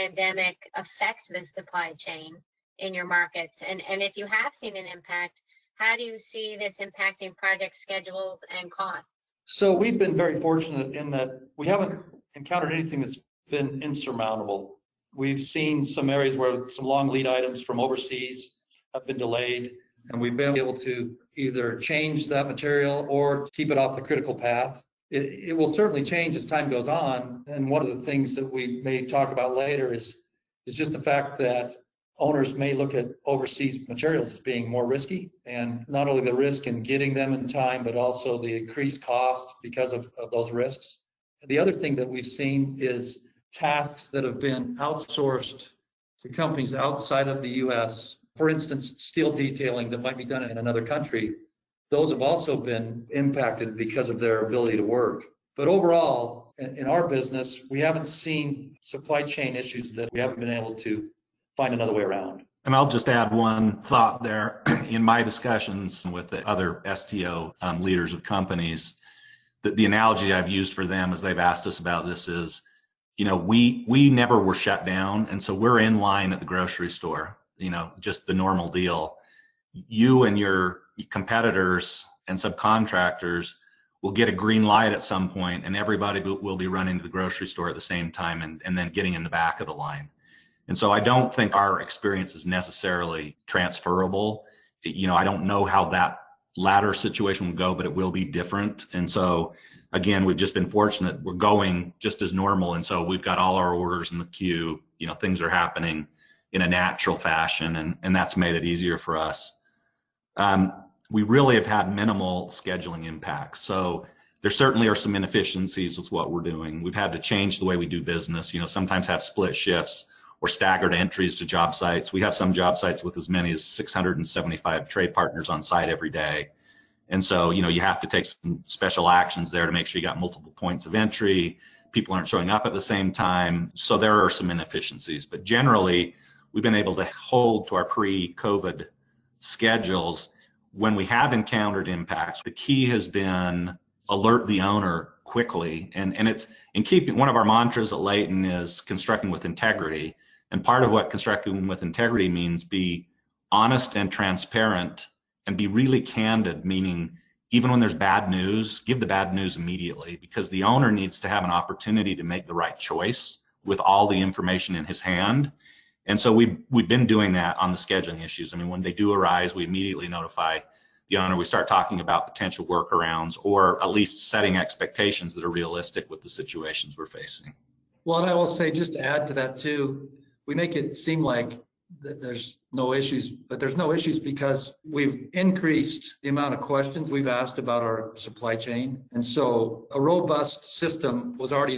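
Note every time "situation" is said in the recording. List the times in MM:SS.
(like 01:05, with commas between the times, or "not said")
01:36, 02:56.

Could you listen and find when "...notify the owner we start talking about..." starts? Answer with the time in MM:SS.
02:50.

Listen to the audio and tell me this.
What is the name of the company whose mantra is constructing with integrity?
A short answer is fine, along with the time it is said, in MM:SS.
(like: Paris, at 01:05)
Layton, at 02:27.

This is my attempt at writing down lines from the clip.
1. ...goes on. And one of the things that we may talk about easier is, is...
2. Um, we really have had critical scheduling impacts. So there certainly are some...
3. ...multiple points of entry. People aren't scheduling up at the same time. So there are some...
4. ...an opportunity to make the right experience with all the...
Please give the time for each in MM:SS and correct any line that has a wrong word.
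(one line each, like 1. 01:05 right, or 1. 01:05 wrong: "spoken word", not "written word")
1. 00:26 wrong: "later", not "easier"
2. 01:50 wrong: "minimal", not "critical"
3. 02:10 wrong: "showing", not "scheduling"
4. 02:41 wrong: "choice", not "experience".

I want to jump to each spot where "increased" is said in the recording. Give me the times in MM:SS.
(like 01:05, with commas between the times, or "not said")
00:38, 03:05.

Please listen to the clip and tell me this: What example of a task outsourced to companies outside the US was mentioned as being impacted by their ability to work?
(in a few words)
Steel detailing.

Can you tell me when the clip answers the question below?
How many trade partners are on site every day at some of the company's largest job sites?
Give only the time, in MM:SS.
02:03.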